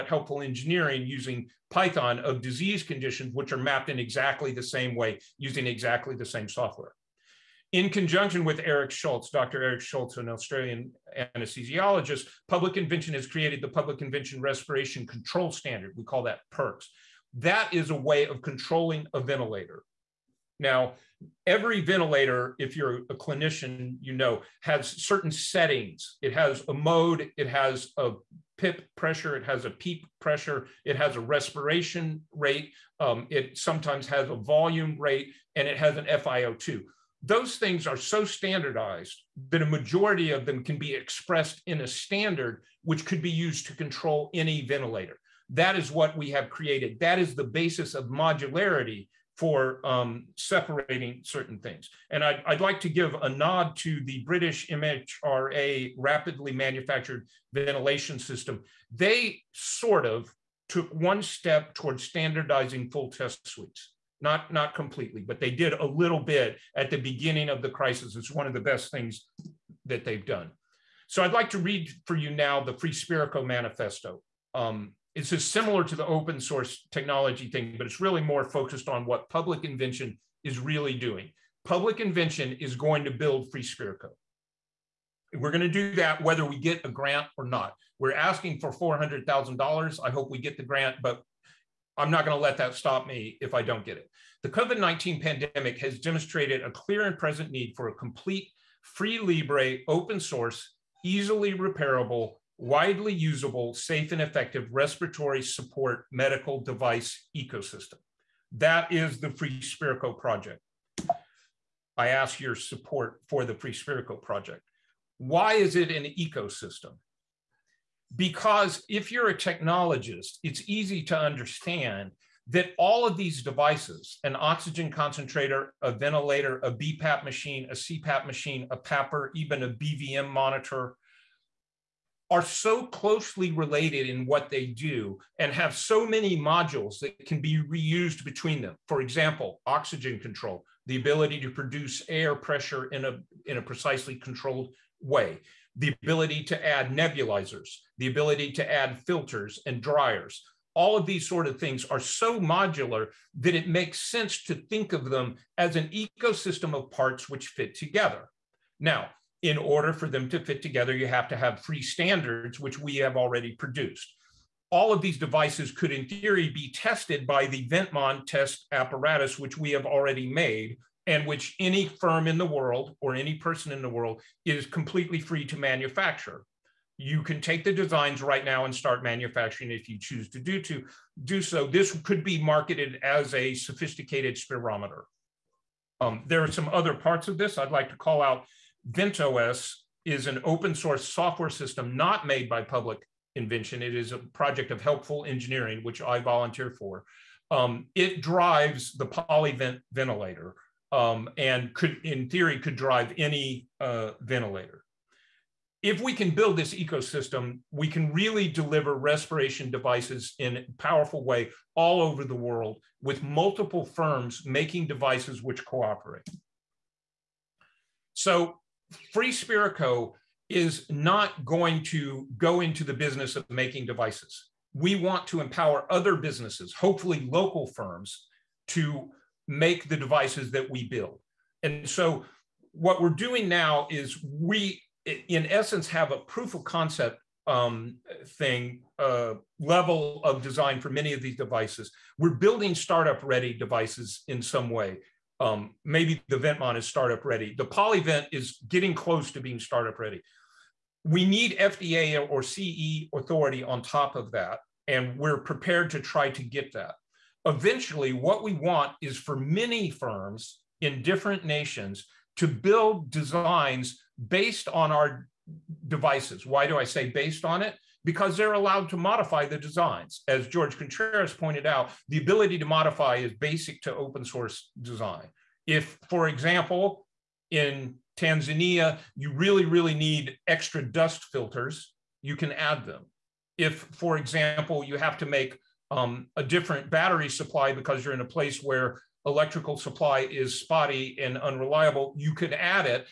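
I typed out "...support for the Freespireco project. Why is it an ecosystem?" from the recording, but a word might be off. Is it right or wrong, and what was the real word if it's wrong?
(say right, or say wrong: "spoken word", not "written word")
right.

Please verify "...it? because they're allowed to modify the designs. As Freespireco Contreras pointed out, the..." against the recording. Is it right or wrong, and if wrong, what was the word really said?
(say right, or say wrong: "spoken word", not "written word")
wrong: "George", not "Freespireco".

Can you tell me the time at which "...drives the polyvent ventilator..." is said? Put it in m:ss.
3:18.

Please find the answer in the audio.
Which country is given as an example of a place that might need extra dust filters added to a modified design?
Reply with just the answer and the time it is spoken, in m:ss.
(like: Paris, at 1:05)
Tanzania, at 4:38.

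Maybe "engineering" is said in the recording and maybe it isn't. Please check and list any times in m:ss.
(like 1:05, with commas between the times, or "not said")
0:00, 3:15.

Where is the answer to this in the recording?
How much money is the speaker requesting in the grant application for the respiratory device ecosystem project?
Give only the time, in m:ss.
1:28.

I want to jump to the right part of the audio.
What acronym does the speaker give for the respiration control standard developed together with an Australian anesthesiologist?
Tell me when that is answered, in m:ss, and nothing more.
0:16.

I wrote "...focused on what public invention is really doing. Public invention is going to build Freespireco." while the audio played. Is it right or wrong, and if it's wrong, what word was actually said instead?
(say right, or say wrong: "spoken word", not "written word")
right.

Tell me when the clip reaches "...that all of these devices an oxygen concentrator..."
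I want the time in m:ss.
2:02.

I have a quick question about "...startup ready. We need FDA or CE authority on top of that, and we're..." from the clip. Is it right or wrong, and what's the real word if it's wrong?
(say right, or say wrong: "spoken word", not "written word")
right.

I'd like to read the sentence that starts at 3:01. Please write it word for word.
This could be marketed as a sophisticated spirometer.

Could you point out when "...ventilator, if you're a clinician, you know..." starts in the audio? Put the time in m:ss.
0:21.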